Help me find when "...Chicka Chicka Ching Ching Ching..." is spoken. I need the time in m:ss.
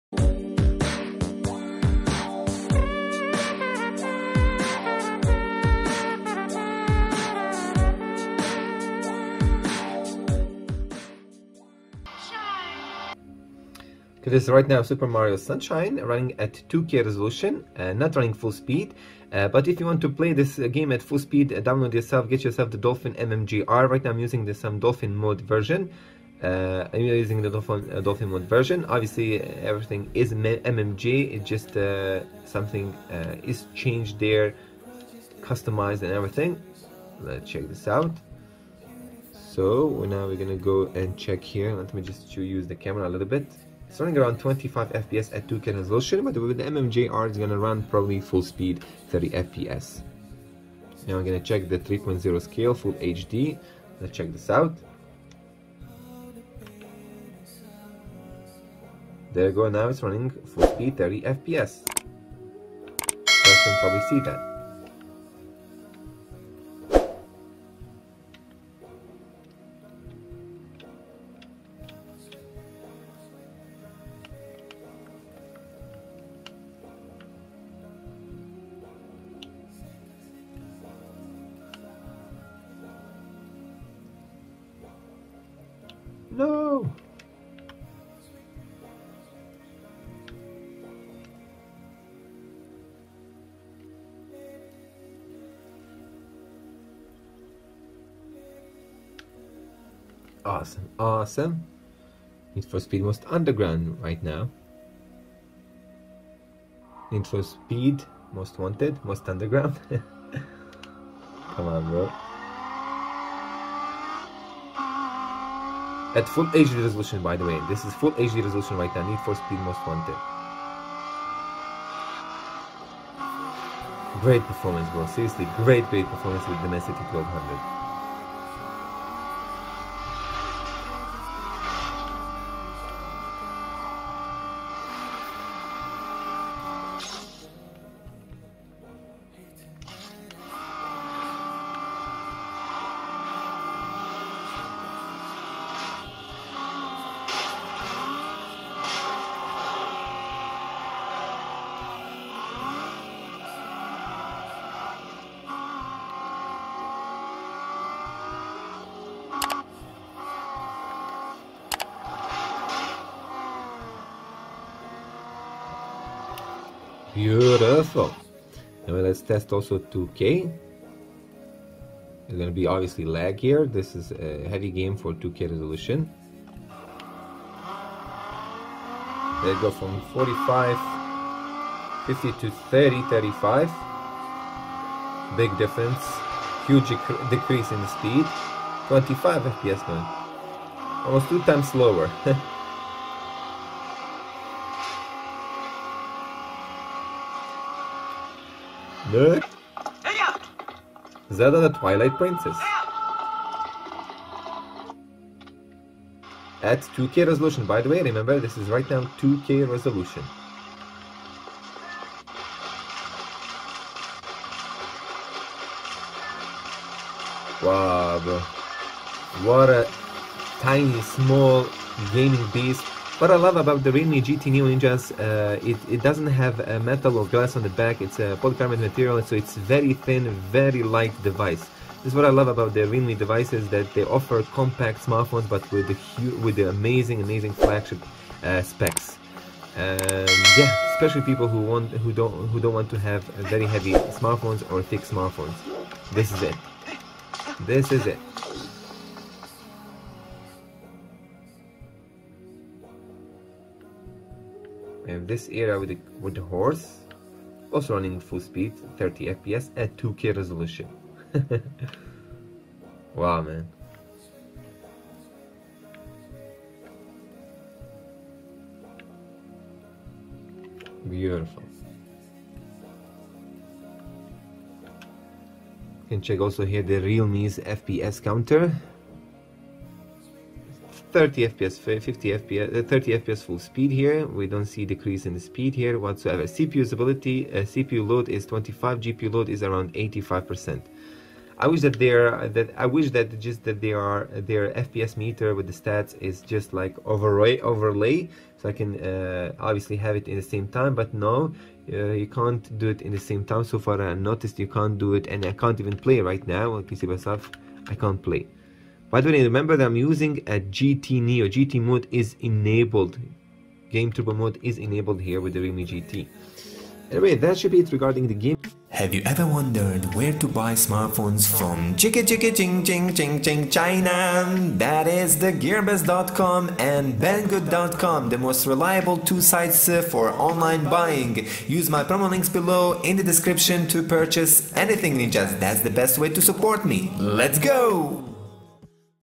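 5:21.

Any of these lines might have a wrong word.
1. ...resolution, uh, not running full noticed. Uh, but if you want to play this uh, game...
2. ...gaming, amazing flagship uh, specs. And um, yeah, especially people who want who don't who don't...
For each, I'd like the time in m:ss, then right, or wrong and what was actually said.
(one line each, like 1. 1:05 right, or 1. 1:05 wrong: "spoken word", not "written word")
1. 0:17 wrong: "speed", not "noticed"
2. 3:56 wrong: "amazing", not "gaming".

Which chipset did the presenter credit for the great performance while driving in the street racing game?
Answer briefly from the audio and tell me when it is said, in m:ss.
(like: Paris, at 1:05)
Dimensity 1200, at 2:06.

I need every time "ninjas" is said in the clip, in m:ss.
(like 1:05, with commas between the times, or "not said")
3:44, 5:35.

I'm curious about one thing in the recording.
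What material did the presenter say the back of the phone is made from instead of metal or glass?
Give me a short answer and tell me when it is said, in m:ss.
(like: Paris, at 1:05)
polycarbonate, at 3:48.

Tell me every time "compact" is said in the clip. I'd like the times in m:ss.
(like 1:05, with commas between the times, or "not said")
3:54.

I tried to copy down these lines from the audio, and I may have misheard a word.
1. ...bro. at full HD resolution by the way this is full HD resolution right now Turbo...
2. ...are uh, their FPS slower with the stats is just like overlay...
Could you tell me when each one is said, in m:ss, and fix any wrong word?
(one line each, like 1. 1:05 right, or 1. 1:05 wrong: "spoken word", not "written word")
1. 1:51 wrong: "Need", not "Turbo"
2. 4:53 wrong: "meter", not "slower".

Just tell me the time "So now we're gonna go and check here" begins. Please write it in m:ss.
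0:39.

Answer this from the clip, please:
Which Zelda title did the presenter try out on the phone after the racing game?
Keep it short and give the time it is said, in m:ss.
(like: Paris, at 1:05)
Twilight Princess, at 3:21.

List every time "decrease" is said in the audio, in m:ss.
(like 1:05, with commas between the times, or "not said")
3:07, 4:44.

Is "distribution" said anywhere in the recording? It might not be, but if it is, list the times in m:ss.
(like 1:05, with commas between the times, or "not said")
not said.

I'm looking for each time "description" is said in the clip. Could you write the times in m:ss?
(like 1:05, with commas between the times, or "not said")
5:33.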